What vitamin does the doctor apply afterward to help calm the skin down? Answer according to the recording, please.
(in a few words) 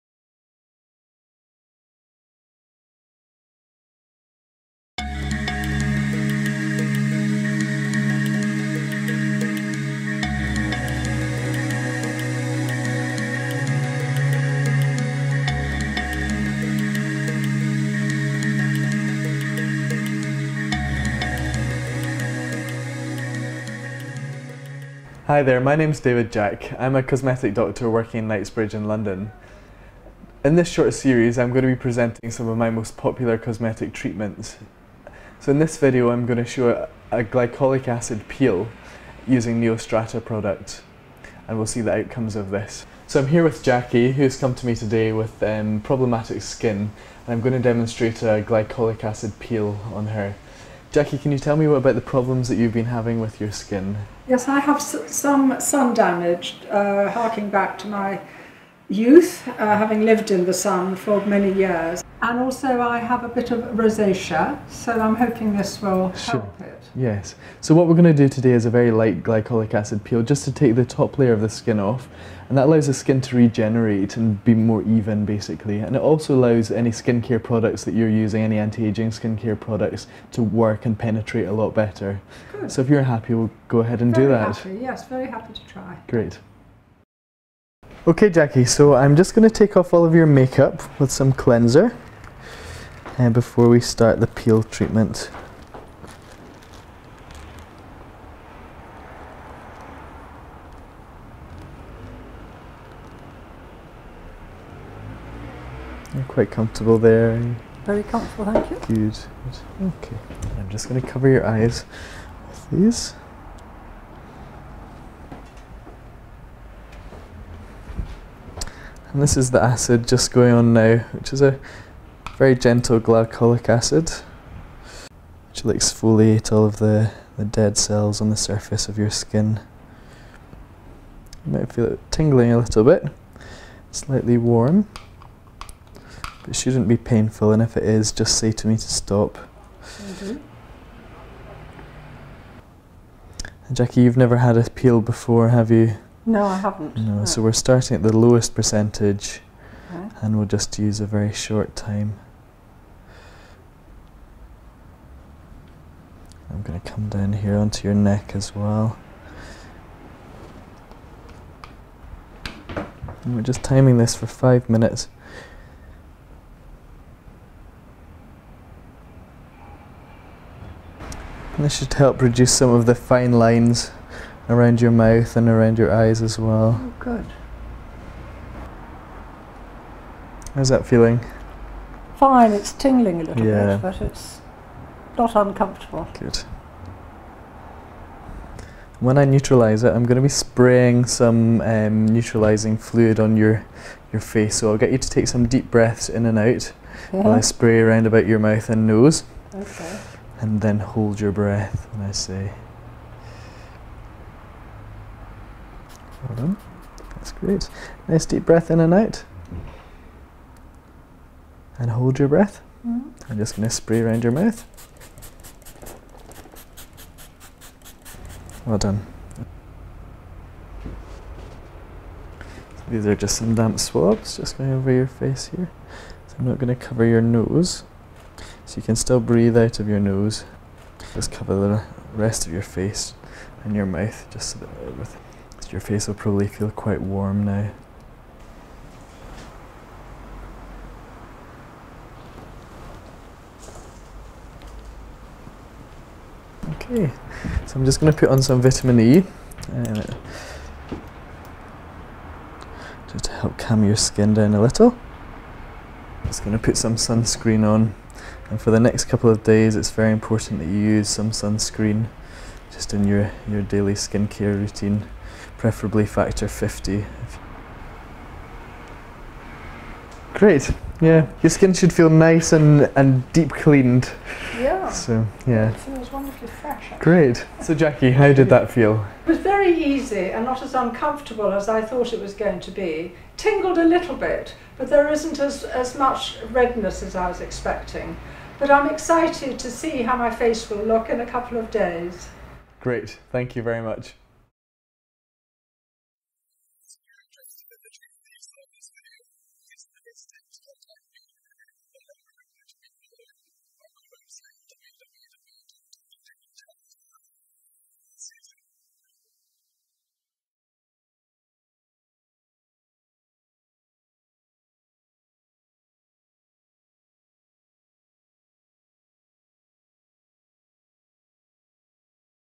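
Vitamin E.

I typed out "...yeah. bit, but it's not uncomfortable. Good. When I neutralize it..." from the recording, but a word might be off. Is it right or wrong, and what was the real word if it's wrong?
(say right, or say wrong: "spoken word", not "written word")
right.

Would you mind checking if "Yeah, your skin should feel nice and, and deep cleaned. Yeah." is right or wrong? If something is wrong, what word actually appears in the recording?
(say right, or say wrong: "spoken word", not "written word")
right.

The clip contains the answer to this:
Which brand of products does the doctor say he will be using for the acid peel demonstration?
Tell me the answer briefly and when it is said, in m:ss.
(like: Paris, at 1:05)
Neostrata, at 0:39.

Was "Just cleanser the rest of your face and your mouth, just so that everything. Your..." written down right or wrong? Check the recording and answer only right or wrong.
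wrong.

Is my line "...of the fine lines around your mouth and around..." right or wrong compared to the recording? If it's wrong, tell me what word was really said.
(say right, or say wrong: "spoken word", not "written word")
right.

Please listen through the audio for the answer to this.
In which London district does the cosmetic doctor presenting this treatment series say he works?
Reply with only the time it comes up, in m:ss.
0:28.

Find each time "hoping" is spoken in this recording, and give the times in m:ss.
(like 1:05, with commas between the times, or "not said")
1:05.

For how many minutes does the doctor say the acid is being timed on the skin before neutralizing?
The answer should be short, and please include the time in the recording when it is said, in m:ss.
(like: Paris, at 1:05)
5, at 2:44.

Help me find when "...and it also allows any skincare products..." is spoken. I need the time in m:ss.
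1:15.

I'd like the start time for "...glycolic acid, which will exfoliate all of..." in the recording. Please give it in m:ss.
2:03.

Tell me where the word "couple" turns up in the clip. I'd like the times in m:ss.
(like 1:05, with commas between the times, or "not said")
4:19, 4:51.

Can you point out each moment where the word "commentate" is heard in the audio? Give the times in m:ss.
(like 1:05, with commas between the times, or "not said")
not said.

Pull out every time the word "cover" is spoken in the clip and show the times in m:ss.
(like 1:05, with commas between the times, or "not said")
1:51, 3:46, 3:51.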